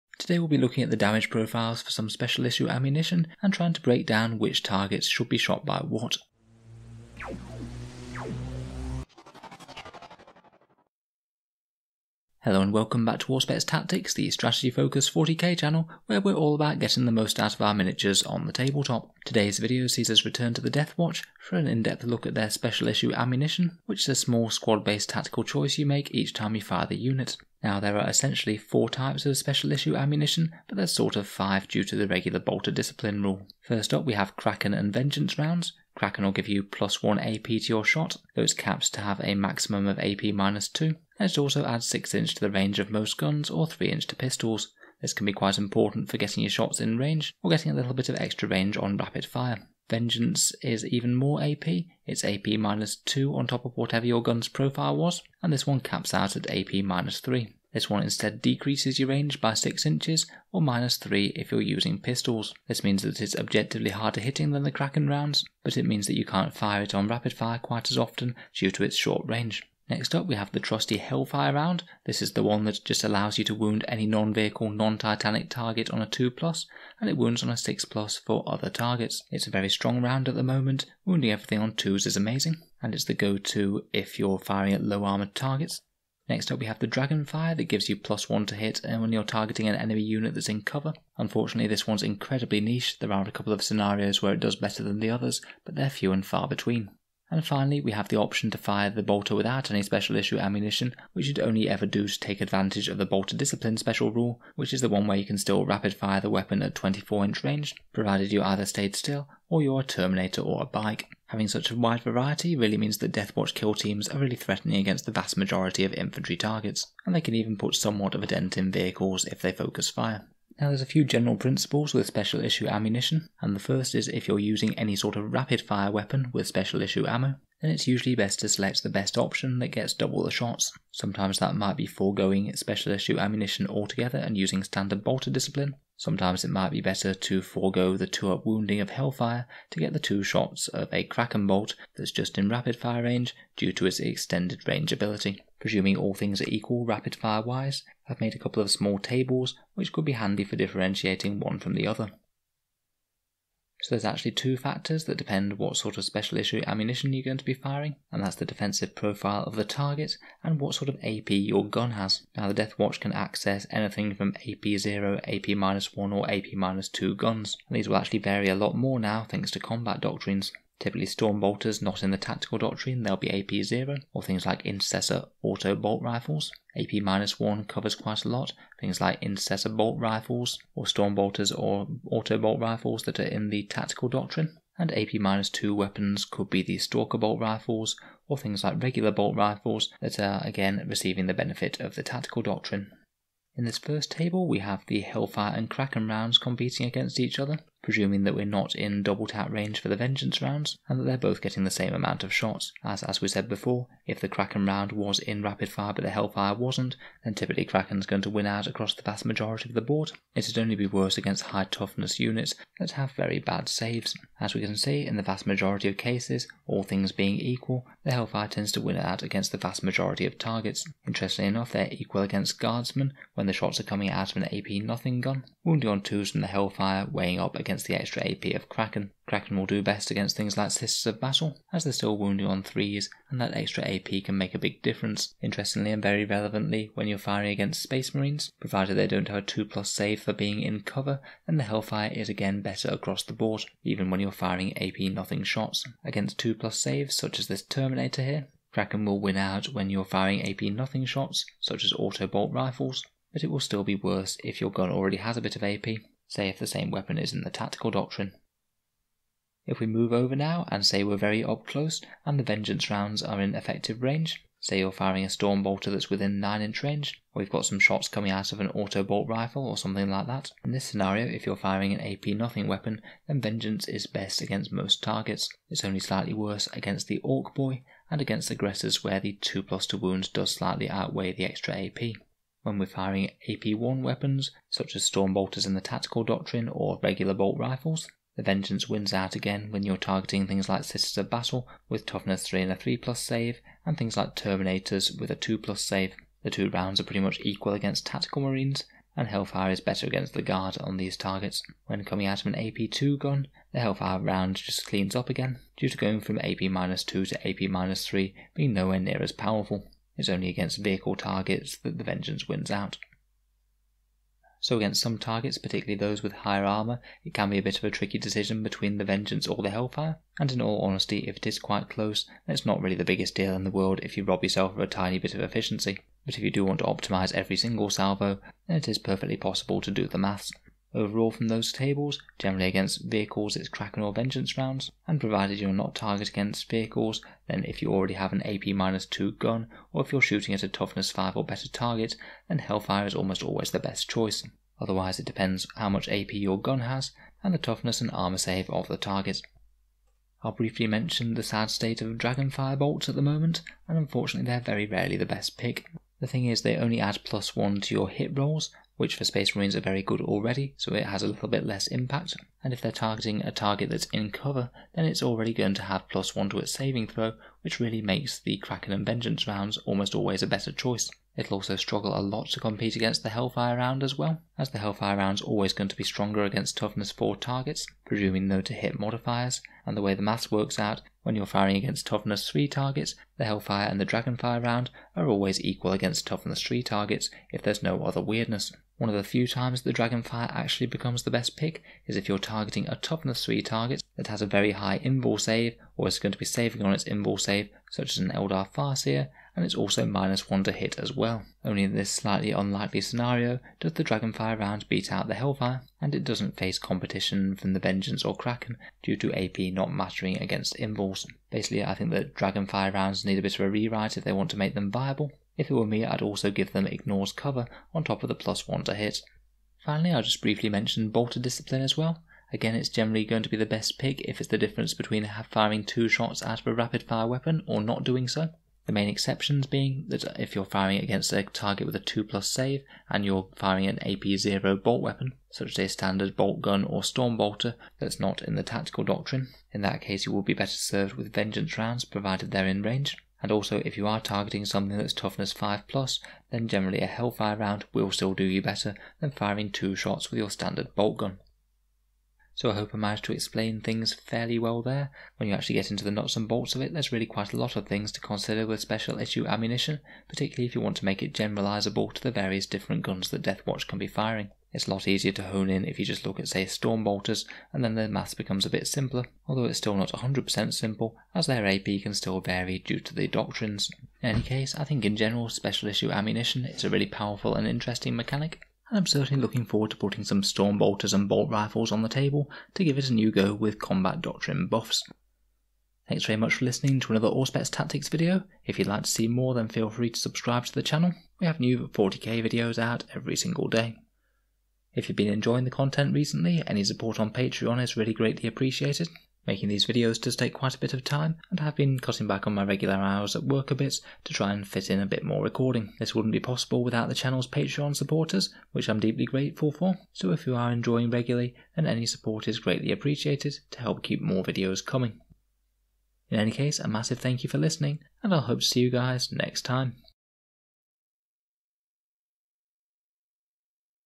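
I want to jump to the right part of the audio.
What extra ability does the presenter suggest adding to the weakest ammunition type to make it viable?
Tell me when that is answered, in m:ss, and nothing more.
6:56.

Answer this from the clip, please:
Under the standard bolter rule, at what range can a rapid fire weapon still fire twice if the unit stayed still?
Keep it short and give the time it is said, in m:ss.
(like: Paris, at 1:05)
24 inch, at 1:46.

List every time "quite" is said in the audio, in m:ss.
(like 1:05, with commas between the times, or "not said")
0:45, 1:07, 2:57, 5:21, 7:37, 8:20.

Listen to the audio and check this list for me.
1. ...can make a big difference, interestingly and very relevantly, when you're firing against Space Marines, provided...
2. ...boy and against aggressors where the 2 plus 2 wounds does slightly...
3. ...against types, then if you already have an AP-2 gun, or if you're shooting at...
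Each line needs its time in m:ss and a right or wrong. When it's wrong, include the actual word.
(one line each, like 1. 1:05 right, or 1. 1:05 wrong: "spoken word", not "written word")
1. 3:54 right
2. 4:37 right
3. 5:36 wrong: "vehicles", not "types".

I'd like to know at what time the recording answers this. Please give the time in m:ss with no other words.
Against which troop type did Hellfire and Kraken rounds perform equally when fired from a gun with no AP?
3:42.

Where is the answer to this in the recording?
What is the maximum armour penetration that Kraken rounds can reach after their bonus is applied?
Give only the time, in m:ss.
0:39.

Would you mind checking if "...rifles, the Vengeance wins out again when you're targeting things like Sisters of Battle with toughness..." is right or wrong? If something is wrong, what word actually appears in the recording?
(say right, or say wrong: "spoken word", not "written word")
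right.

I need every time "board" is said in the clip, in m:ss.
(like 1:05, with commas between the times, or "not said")
3:29, 4:03.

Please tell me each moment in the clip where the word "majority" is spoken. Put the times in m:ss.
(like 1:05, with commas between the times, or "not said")
1:55, 3:29, 3:35, 3:39.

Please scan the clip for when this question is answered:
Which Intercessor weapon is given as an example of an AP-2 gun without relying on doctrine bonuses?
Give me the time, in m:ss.
3:06.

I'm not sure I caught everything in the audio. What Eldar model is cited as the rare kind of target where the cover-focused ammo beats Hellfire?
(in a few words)
Eldar Farseer.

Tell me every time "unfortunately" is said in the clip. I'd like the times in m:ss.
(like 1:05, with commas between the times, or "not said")
1:31, 5:53.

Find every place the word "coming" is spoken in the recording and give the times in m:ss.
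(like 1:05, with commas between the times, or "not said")
3:43, 4:28, 5:02, 8:34.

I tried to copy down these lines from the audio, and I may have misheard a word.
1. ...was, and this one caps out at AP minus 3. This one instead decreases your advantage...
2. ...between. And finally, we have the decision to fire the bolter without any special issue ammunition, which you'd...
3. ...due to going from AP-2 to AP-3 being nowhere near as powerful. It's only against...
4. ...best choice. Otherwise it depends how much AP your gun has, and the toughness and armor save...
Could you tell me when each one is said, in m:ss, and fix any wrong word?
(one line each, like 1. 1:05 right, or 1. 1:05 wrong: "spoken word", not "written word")
1. 0:54 wrong: "range", not "advantage"
2. 1:36 wrong: "option", not "decision"
3. 5:05 right
4. 5:43 right.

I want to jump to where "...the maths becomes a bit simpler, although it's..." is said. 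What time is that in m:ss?
7:47.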